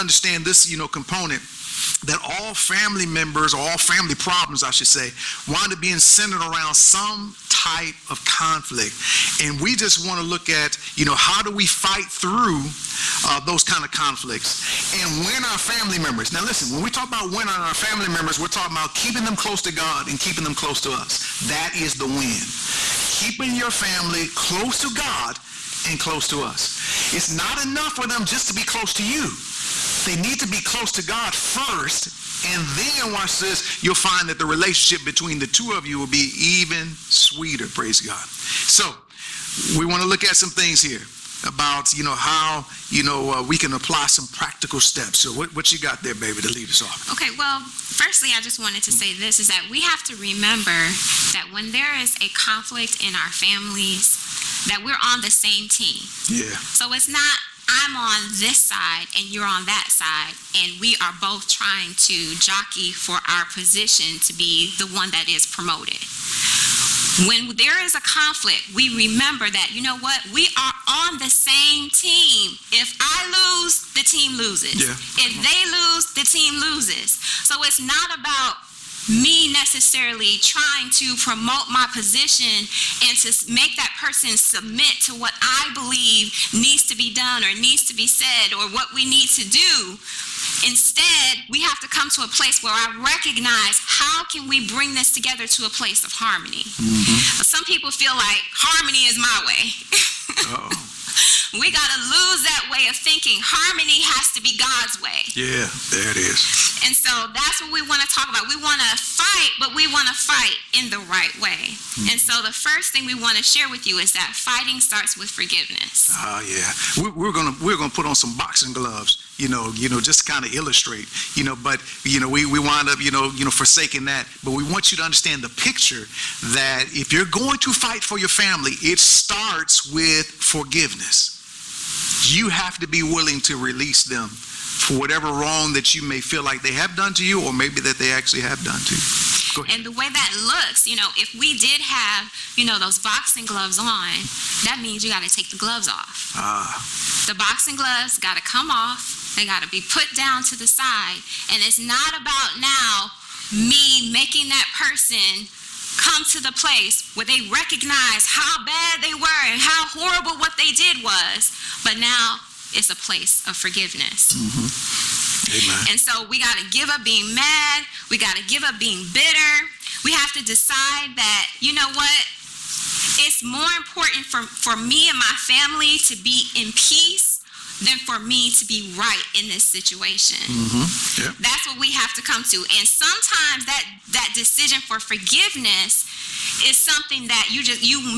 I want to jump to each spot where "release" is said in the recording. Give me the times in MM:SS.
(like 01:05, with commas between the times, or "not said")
02:13.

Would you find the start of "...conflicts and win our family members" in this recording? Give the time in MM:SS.
00:13.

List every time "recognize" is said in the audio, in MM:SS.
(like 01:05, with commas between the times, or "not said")
01:33, 02:37.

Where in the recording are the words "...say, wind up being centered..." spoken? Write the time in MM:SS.
00:04.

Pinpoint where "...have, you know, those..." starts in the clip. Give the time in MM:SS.
02:21.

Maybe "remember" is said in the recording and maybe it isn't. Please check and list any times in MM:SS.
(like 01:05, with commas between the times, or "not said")
00:50, 01:08.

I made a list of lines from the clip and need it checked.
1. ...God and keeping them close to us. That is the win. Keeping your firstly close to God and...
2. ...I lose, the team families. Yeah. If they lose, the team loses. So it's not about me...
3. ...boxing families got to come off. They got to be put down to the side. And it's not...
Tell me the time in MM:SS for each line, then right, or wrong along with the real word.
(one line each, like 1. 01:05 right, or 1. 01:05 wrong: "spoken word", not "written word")
1. 00:19 wrong: "family", not "firstly"
2. 01:12 wrong: "loses", not "families"
3. 02:27 wrong: "gloves", not "families".